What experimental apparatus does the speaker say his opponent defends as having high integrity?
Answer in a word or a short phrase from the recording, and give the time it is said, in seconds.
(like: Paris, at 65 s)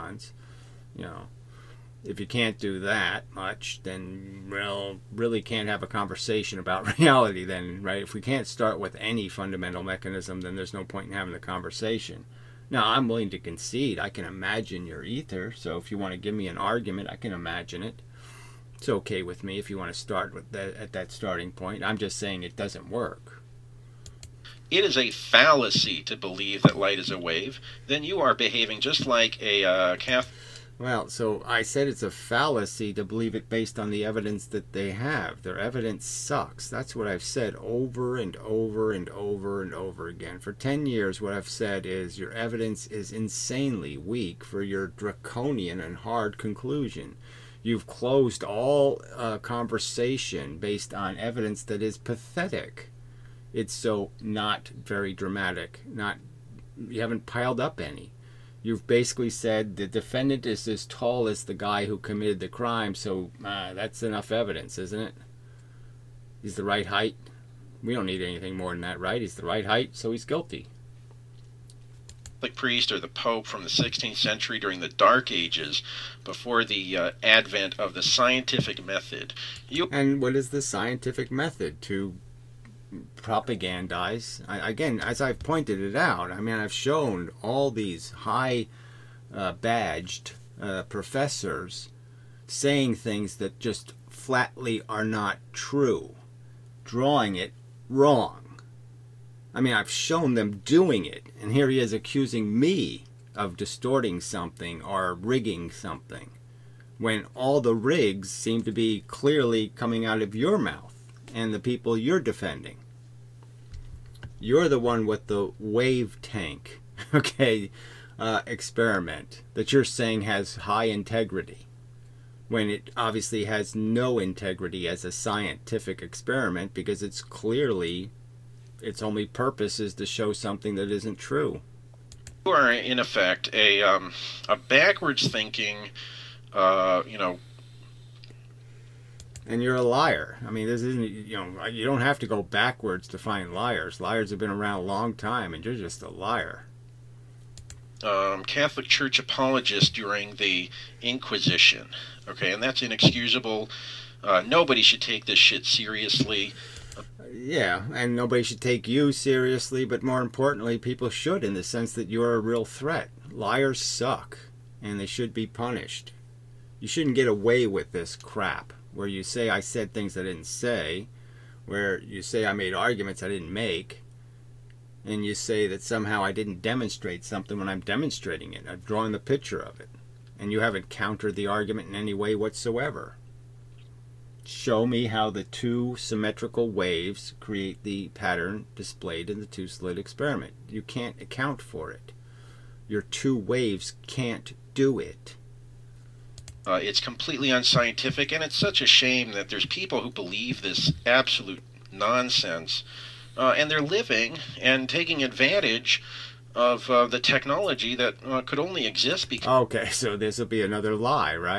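wave tank, at 115 s.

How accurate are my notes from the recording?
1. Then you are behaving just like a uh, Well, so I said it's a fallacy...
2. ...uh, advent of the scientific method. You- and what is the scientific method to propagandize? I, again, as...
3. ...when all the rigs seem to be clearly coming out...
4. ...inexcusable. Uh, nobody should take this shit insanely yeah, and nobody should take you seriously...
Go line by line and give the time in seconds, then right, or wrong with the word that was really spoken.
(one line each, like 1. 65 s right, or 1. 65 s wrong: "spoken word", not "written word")
1. 27 s right
2. 76 s right
3. 106 s right
4. 152 s wrong: "seriously", not "insanely".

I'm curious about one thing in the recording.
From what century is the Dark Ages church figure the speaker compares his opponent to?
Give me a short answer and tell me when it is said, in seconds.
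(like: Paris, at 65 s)
16th century, at 73 s.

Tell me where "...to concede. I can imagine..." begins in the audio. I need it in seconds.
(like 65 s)
13 s.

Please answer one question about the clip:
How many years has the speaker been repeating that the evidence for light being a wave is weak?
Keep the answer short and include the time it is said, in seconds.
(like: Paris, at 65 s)
10 years, at 40 s.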